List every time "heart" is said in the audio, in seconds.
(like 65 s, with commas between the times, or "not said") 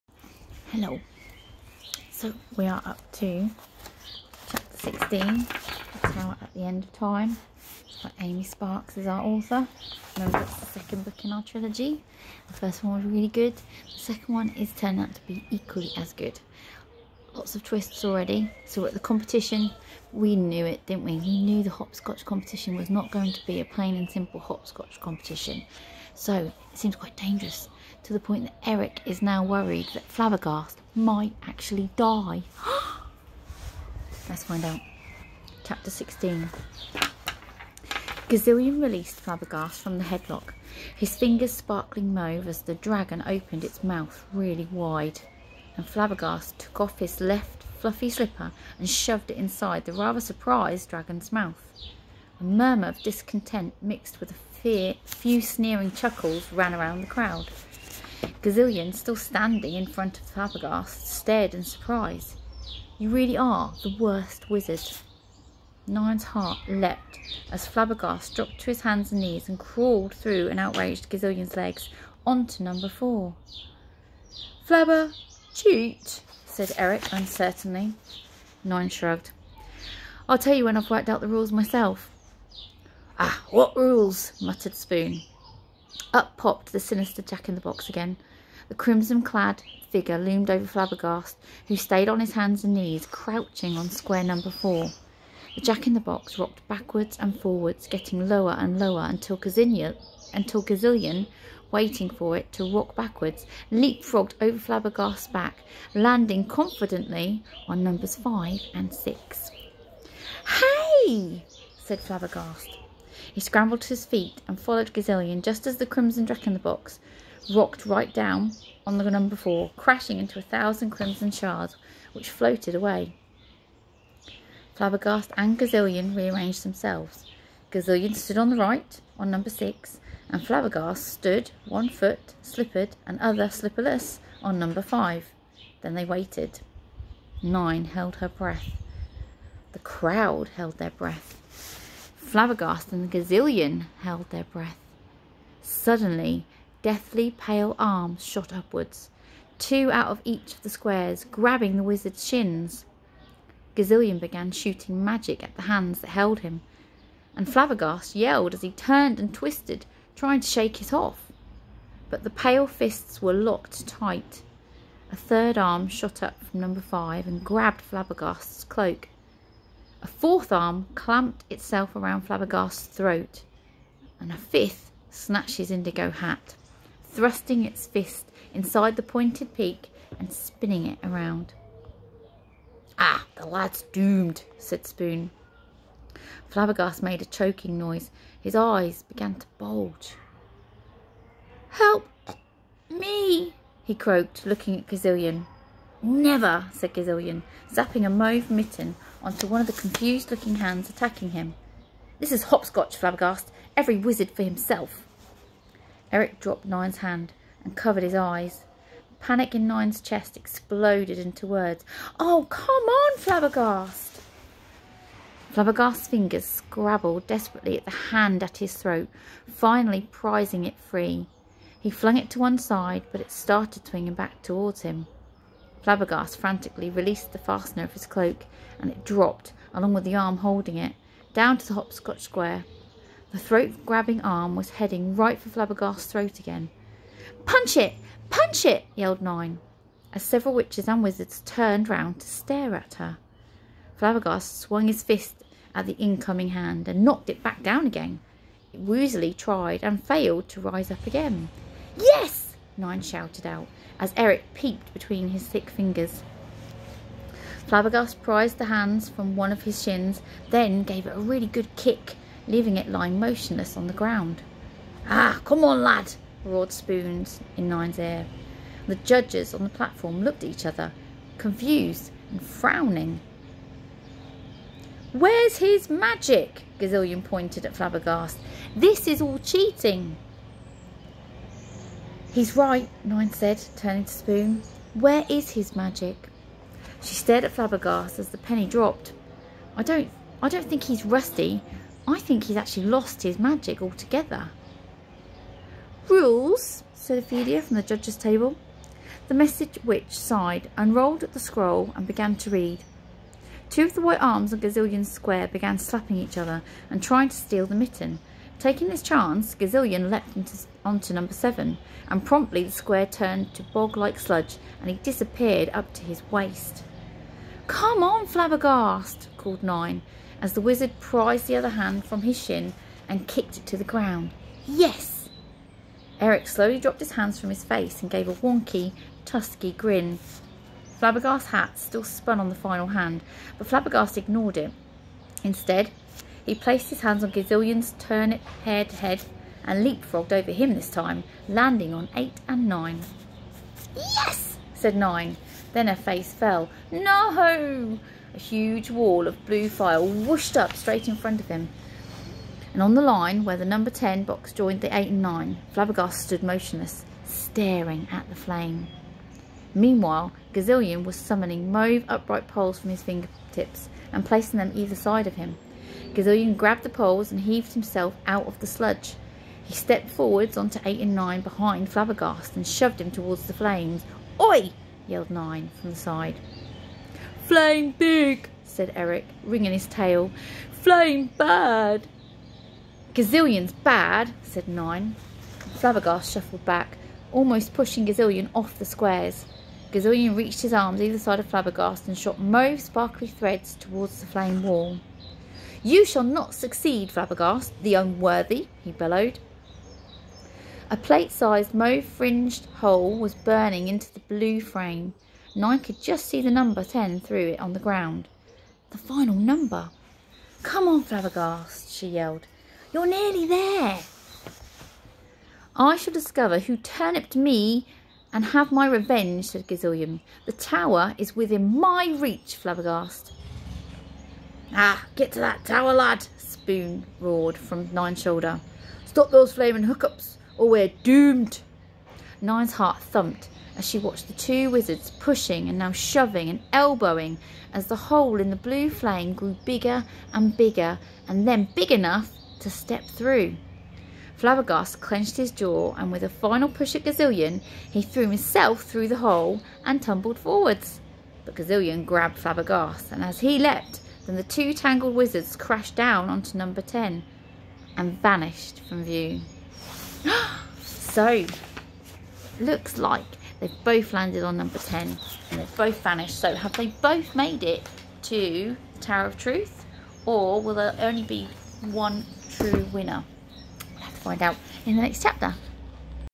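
66 s, 432 s.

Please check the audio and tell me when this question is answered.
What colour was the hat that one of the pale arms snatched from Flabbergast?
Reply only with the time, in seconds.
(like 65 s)
175 s.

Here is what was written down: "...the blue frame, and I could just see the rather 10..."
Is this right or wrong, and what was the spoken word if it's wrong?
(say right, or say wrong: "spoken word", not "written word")
wrong: "number", not "rather".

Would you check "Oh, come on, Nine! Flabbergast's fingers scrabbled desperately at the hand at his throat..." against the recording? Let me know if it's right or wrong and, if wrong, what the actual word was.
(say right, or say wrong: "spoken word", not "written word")
wrong: "Flabbergast", not "Nine".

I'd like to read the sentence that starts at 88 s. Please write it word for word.
The crimson clad figure loomed over Flabbergast, who stayed on his hands and knees, crouching on square number four.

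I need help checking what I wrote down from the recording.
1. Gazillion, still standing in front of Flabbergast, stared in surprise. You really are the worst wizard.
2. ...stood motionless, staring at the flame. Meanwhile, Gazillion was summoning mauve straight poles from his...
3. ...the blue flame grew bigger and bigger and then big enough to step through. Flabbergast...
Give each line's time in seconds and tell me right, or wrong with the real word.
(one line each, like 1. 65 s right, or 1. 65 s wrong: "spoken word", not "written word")
1. 58 s right
2. 356 s wrong: "upright", not "straight"
3. 438 s right.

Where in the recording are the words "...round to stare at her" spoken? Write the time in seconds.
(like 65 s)
241 s.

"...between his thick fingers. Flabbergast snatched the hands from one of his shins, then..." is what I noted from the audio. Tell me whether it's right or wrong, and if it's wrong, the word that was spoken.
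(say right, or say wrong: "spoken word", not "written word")
wrong: "prized", not "snatched".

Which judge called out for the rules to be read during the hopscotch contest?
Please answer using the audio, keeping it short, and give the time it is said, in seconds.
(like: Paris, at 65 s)
Ophelia, at 297 s.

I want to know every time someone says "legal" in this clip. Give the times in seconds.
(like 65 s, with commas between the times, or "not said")
not said.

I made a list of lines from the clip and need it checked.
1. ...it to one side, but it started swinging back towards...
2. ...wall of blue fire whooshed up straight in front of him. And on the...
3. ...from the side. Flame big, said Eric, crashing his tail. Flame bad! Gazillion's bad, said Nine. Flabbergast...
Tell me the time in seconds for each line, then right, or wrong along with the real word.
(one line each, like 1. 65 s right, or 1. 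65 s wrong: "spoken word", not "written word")
1. 222 s right
2. 348 s right
3. 375 s wrong: "wringing", not "crashing".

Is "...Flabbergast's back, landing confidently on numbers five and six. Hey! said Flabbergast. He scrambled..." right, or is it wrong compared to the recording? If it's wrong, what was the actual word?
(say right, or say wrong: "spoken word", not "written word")
right.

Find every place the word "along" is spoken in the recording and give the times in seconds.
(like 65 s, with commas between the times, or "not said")
229 s.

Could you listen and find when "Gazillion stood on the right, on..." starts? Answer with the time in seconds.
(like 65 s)
127 s.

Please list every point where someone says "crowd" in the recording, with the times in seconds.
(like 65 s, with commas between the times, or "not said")
57 s, 139 s.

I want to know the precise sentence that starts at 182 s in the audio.
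Ah, the lad's doomed, said Spoon.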